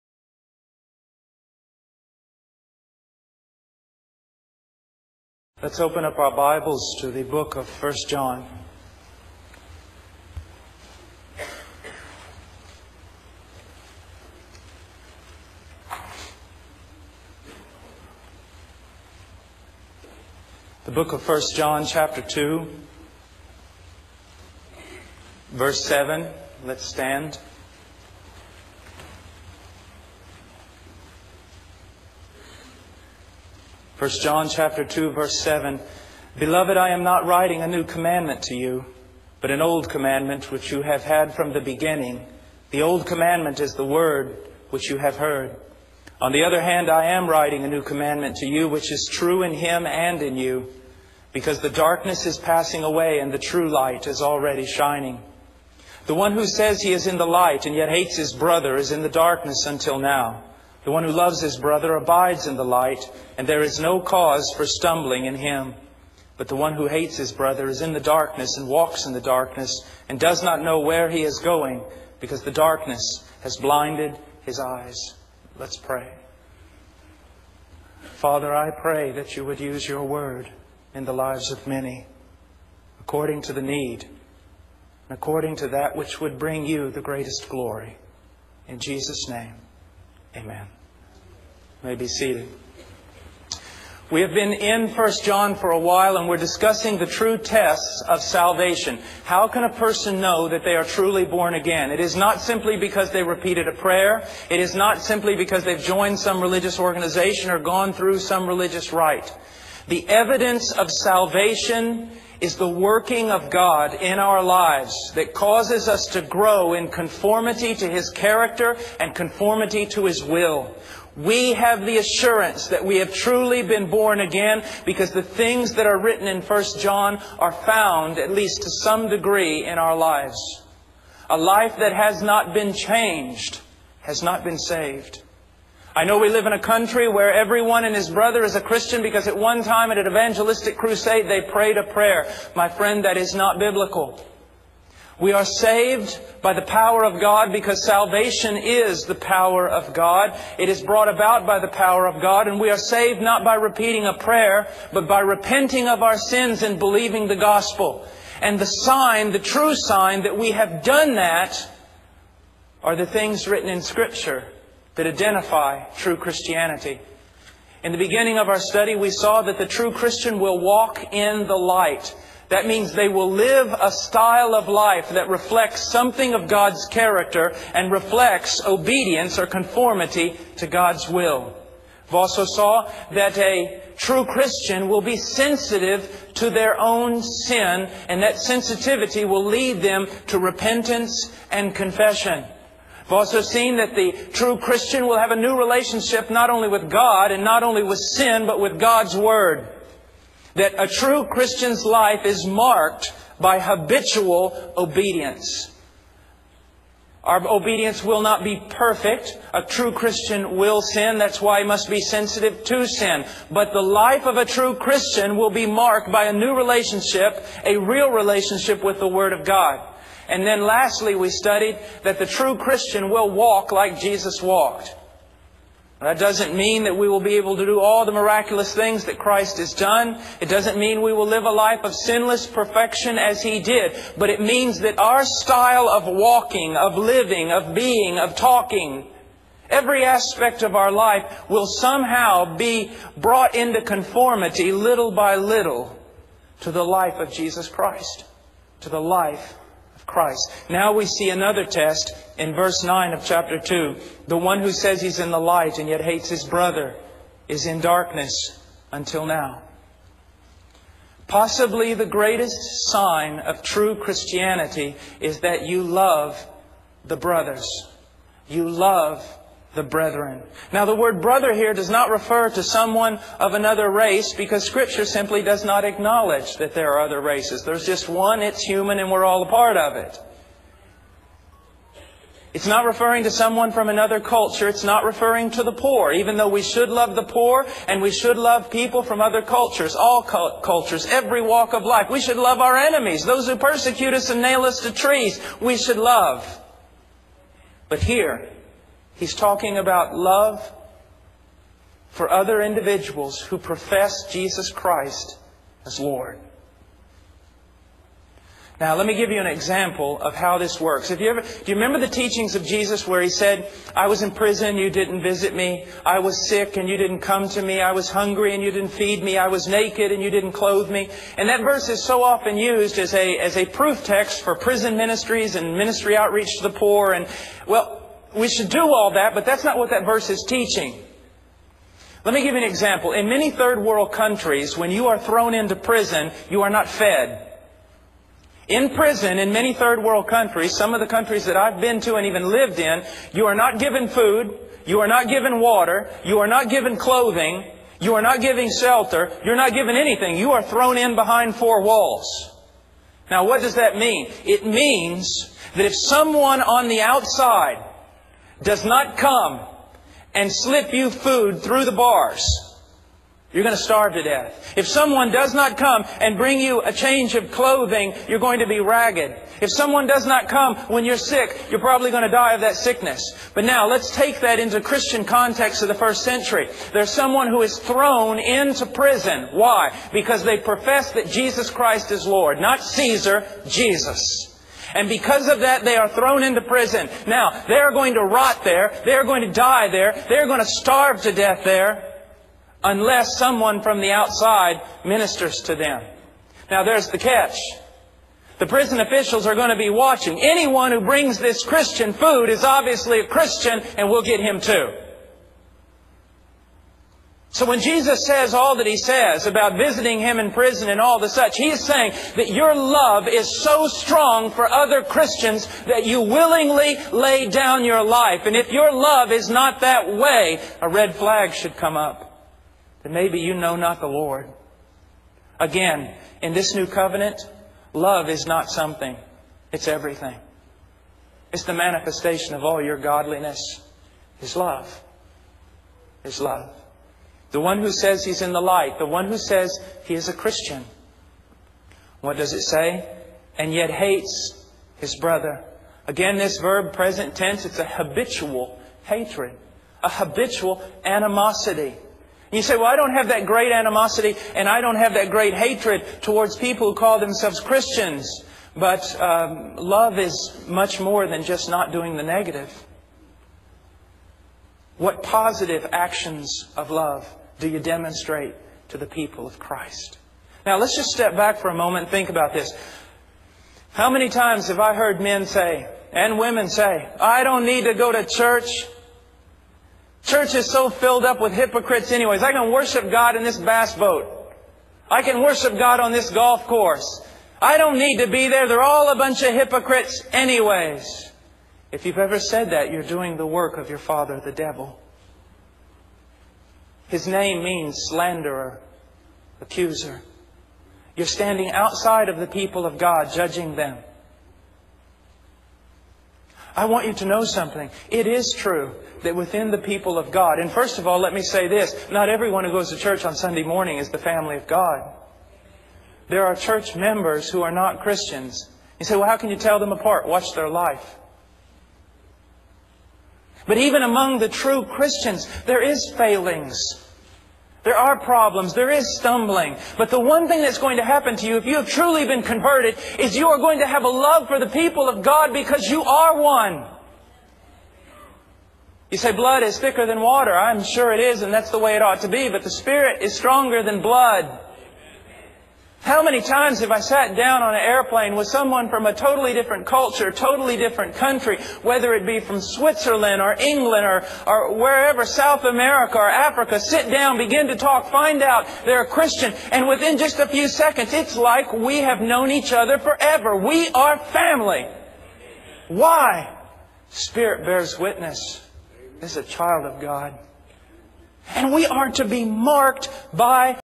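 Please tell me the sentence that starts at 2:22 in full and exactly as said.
My friend, that is not biblical.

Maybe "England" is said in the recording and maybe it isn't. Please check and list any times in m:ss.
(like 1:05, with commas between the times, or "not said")
9:13.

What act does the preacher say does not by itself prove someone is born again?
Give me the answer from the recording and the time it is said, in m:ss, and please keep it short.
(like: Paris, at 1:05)
Repeating a prayer, at 1:43.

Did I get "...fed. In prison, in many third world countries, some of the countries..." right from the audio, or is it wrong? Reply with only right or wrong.
right.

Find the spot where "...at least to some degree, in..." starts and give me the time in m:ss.
2:08.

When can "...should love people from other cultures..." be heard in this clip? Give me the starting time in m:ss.
4:48.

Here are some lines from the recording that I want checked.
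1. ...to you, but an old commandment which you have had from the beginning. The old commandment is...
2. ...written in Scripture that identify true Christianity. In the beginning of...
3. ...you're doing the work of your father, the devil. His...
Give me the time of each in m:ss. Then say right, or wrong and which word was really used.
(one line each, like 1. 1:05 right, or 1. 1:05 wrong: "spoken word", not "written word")
1. 0:38 right
2. 2:43 right
3. 8:12 right.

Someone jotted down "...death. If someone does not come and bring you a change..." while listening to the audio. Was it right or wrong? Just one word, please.
right.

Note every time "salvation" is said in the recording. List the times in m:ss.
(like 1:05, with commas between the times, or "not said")
1:38, 1:50, 2:27.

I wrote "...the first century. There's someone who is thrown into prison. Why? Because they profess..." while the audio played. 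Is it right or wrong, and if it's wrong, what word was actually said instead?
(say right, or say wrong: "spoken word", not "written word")
right.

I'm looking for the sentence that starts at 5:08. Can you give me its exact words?
Now, let me give you an example of how this works.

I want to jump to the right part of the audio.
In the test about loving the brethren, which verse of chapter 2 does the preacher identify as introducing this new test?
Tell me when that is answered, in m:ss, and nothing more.
4:12.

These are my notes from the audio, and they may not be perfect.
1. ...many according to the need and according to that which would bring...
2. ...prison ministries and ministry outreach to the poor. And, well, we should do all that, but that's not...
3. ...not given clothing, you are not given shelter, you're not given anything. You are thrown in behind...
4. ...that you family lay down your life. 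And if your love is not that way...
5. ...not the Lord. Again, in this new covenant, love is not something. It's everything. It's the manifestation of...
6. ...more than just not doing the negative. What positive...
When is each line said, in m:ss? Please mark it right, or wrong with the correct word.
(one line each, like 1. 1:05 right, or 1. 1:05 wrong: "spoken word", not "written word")
1. 1:21 right
2. 5:24 right
3. 5:46 right
4. 6:55 wrong: "willingly", not "family"
5. 7:03 right
6. 7:41 right.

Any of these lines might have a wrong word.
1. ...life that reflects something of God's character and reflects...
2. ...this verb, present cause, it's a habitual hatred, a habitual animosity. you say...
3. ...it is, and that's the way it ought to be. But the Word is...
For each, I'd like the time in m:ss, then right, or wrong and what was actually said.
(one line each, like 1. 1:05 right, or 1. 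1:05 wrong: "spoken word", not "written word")
1. 2:54 right
2. 7:26 wrong: "tense", not "cause"
3. 9:01 wrong: "Spirit", not "Word".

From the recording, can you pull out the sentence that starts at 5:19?
I was naked, and you didn't clothe me.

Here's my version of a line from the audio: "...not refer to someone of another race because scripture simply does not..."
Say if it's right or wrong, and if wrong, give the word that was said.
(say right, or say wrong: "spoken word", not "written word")
right.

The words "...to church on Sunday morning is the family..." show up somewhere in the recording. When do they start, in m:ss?
8:32.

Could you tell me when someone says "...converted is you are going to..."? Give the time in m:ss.
8:52.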